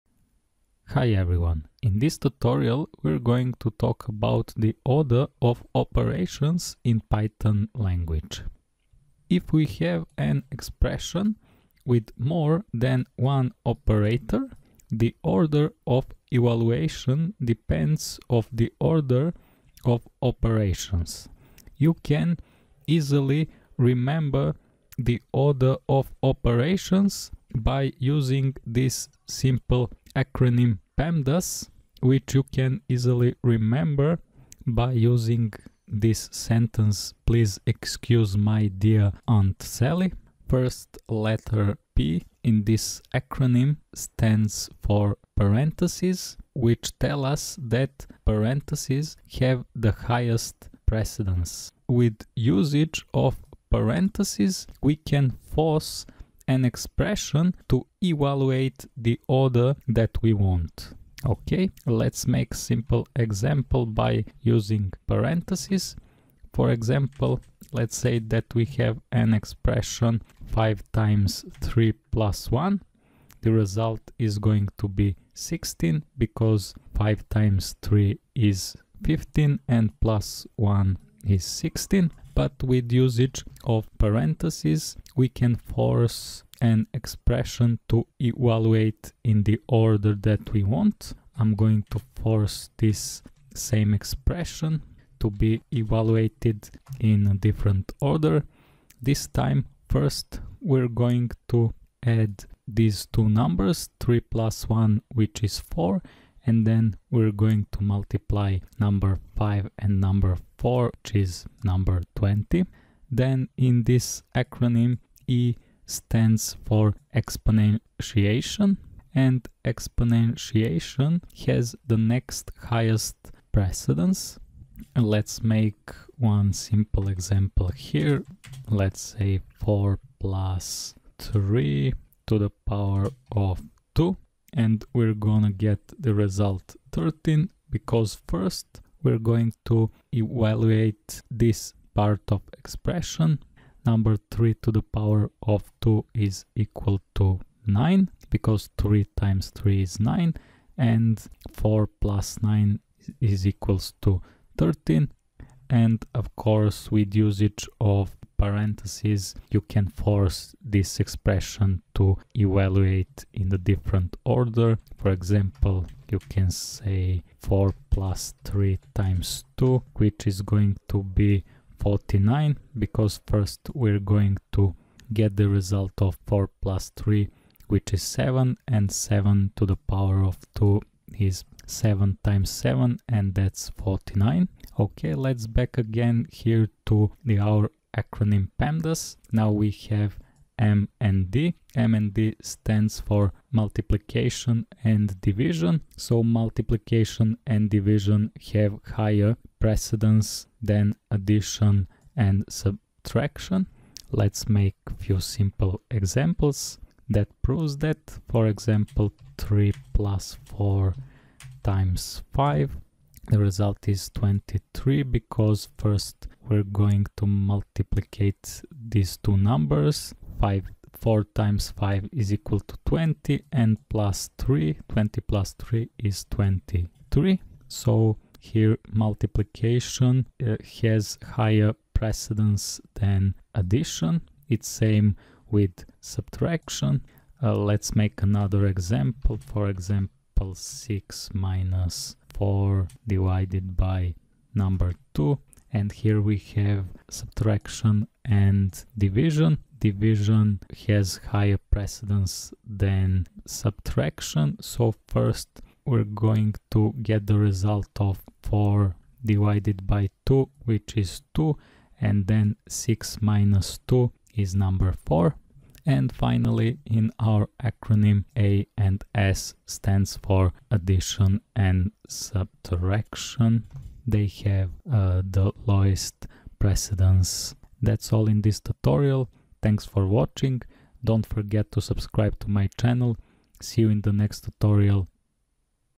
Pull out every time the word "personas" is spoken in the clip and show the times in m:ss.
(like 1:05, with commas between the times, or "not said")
not said.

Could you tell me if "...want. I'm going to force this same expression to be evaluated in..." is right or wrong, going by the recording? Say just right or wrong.
right.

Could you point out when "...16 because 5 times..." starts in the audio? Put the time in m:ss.
1:15.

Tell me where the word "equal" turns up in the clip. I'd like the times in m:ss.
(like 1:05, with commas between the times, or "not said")
2:26, 2:33, 3:42.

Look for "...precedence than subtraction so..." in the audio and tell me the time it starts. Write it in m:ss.
4:11.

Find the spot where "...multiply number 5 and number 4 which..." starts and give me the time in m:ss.
1:47.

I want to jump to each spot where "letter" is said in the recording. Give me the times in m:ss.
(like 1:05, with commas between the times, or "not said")
0:41.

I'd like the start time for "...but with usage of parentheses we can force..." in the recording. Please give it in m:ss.
1:22.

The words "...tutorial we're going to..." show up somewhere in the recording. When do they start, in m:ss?
0:02.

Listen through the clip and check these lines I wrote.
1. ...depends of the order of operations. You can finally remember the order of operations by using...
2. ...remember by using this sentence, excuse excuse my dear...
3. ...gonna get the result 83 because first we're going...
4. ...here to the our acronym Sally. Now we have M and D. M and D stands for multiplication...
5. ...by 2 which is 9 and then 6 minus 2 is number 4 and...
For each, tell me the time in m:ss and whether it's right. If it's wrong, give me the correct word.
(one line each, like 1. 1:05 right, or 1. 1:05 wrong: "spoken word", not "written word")
1. 0:17 wrong: "easily", not "finally"
2. 0:33 wrong: "please", not "excuse"
3. 2:15 wrong: "13", not "83"
4. 3:06 wrong: "PEMDAS", not "Sally"
5. 4:19 wrong: "2", not "9".